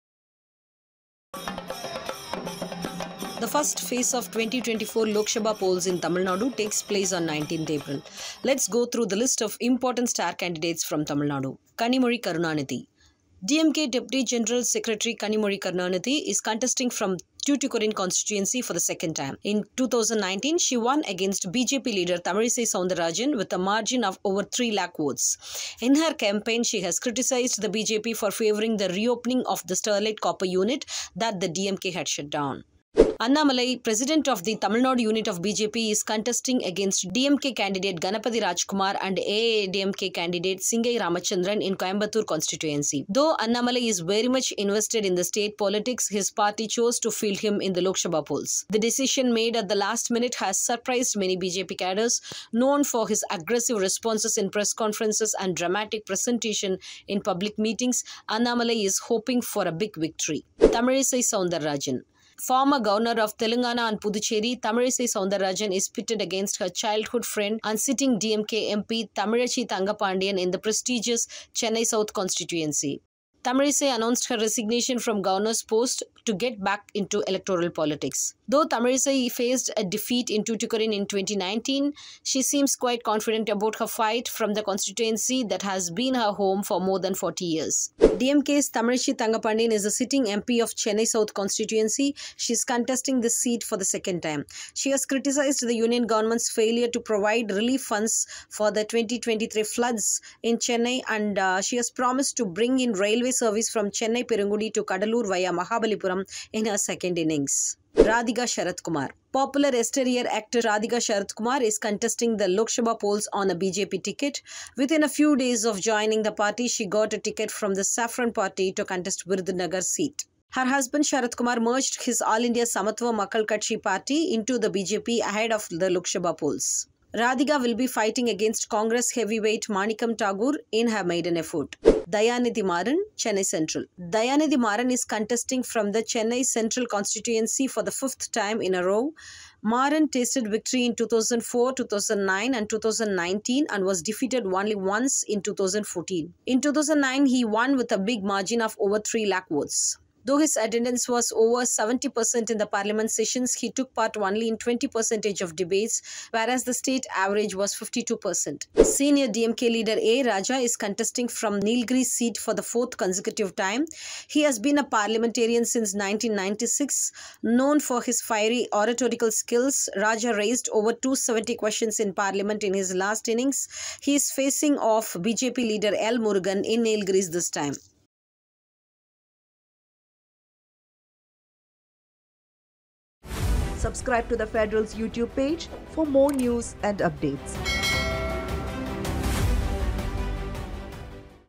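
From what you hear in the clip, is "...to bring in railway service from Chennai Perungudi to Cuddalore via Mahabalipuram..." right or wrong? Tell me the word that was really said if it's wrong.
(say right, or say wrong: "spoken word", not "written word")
right.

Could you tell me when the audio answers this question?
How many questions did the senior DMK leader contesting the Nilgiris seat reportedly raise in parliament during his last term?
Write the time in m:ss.
2:50.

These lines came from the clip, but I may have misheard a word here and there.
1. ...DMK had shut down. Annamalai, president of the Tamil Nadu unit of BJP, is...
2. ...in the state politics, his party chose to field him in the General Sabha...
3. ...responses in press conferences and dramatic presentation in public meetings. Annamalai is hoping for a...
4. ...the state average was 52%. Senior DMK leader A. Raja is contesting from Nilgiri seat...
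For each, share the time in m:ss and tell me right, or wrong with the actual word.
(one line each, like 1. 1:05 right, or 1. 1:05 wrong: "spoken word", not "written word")
1. 0:31 right
2. 0:45 wrong: "Lok", not "General"
3. 0:53 right
4. 2:36 right.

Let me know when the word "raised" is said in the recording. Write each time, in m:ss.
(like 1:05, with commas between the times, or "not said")
2:50.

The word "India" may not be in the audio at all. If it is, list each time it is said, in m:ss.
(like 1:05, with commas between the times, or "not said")
2:02.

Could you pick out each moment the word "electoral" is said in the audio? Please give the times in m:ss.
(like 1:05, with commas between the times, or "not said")
1:17.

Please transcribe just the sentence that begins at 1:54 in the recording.
Within a few days of joining the party, she got a ticket from the Saffron Party to contest Virudhunagar seat.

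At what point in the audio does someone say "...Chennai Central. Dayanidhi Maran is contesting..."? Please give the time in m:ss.
2:13.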